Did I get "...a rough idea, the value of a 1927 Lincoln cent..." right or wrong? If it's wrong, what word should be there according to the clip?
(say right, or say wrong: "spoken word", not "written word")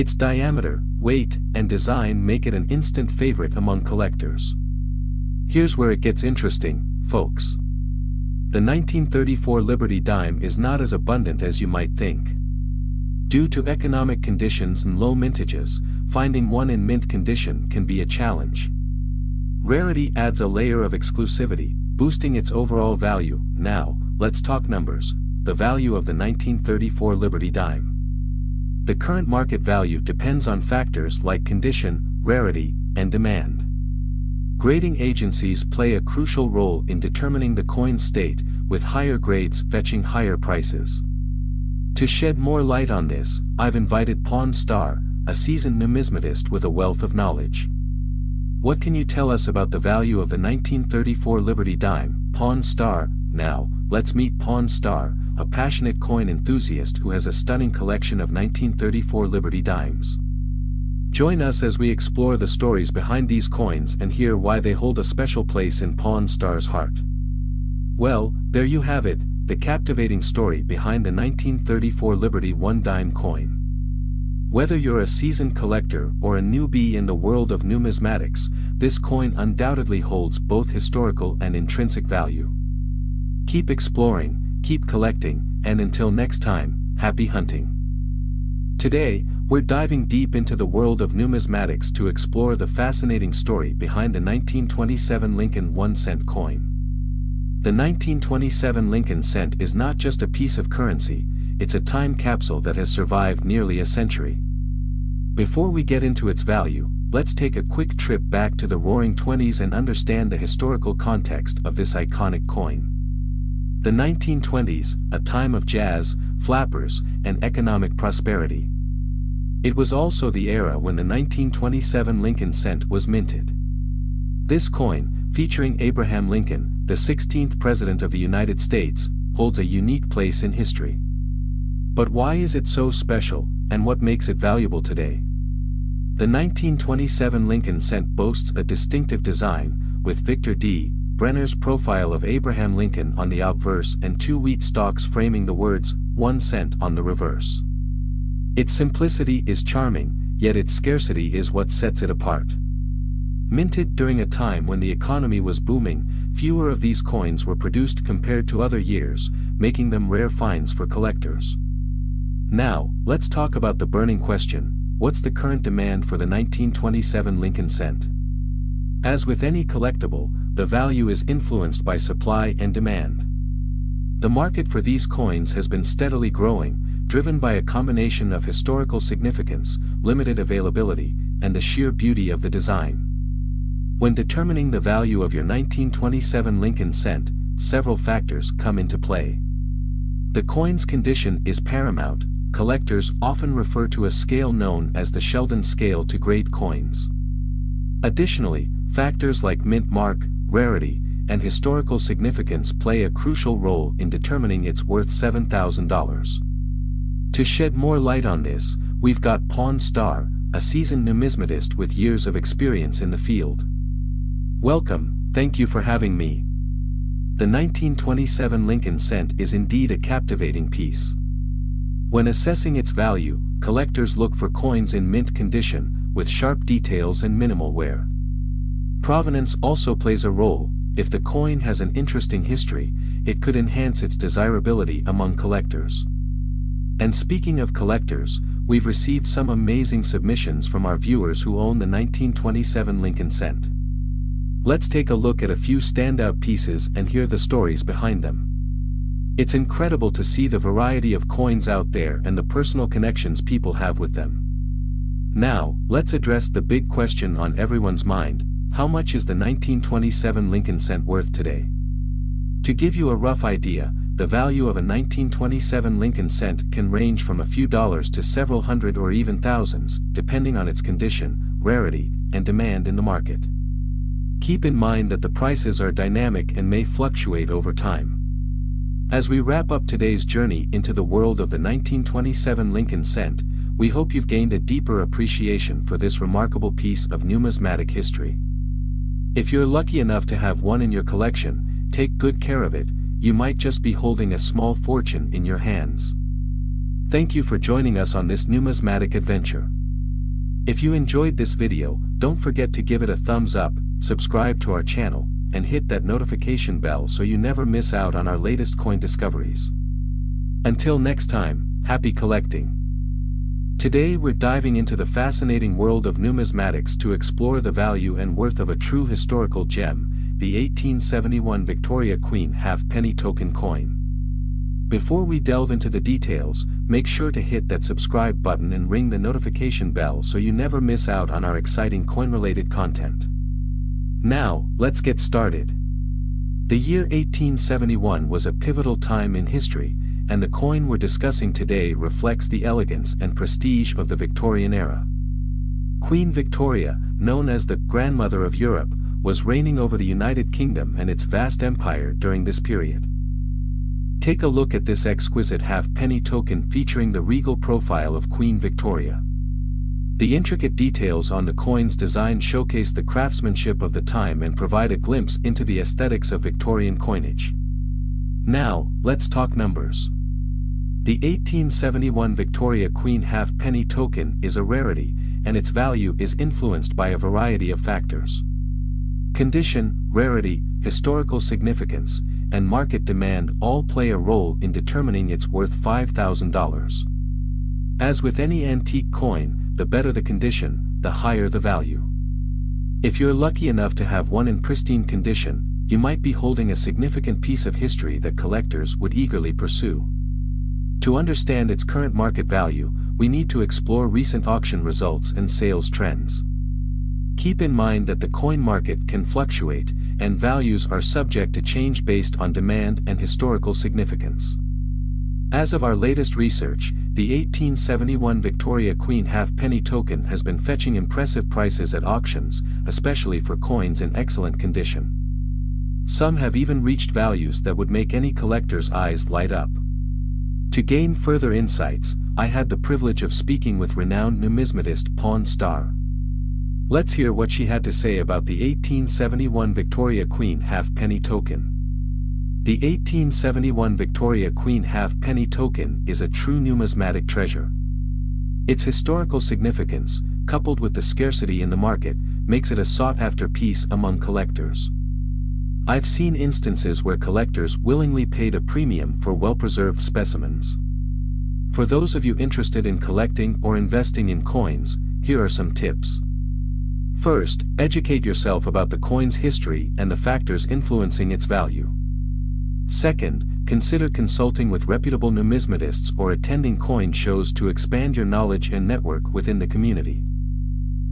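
right.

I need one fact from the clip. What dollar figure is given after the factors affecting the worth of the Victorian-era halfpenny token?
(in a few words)
$5,000.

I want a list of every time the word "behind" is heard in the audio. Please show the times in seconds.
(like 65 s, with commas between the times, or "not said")
62 s, 70 s, 93 s, 247 s.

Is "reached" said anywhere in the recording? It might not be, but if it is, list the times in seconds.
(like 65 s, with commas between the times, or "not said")
426 s.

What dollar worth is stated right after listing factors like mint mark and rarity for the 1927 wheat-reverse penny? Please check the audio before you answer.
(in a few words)
$7,000.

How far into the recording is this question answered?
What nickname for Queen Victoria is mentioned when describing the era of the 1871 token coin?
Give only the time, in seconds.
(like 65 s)
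347 s.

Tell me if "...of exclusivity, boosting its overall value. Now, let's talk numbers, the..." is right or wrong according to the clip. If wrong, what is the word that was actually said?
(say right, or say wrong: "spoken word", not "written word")
right.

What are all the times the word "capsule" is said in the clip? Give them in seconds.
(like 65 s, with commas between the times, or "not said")
102 s.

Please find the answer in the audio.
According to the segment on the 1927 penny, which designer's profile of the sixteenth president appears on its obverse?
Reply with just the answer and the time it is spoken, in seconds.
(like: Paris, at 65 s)
Victor D. Brenner, at 140 s.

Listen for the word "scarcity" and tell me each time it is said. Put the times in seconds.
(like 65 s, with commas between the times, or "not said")
150 s, 451 s.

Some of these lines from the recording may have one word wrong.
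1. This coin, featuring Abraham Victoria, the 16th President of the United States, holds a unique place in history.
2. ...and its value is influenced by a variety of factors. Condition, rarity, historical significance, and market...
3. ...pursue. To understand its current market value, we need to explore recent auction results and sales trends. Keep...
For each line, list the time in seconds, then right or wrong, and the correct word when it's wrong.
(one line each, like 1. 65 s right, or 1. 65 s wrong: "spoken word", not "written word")
1. 124 s wrong: "Lincoln", not "Victoria"
2. 375 s right
3. 399 s right.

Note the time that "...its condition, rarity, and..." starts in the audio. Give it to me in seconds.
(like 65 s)
270 s.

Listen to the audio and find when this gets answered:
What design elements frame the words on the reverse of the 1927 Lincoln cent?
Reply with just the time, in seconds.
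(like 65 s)
144 s.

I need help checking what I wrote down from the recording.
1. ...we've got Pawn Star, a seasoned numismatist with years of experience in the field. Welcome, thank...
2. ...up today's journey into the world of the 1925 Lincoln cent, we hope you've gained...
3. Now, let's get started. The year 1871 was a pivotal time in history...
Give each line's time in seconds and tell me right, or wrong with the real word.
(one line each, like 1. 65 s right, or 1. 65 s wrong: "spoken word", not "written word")
1. 209 s right
2. 279 s wrong: "1927", not "1925"
3. 334 s right.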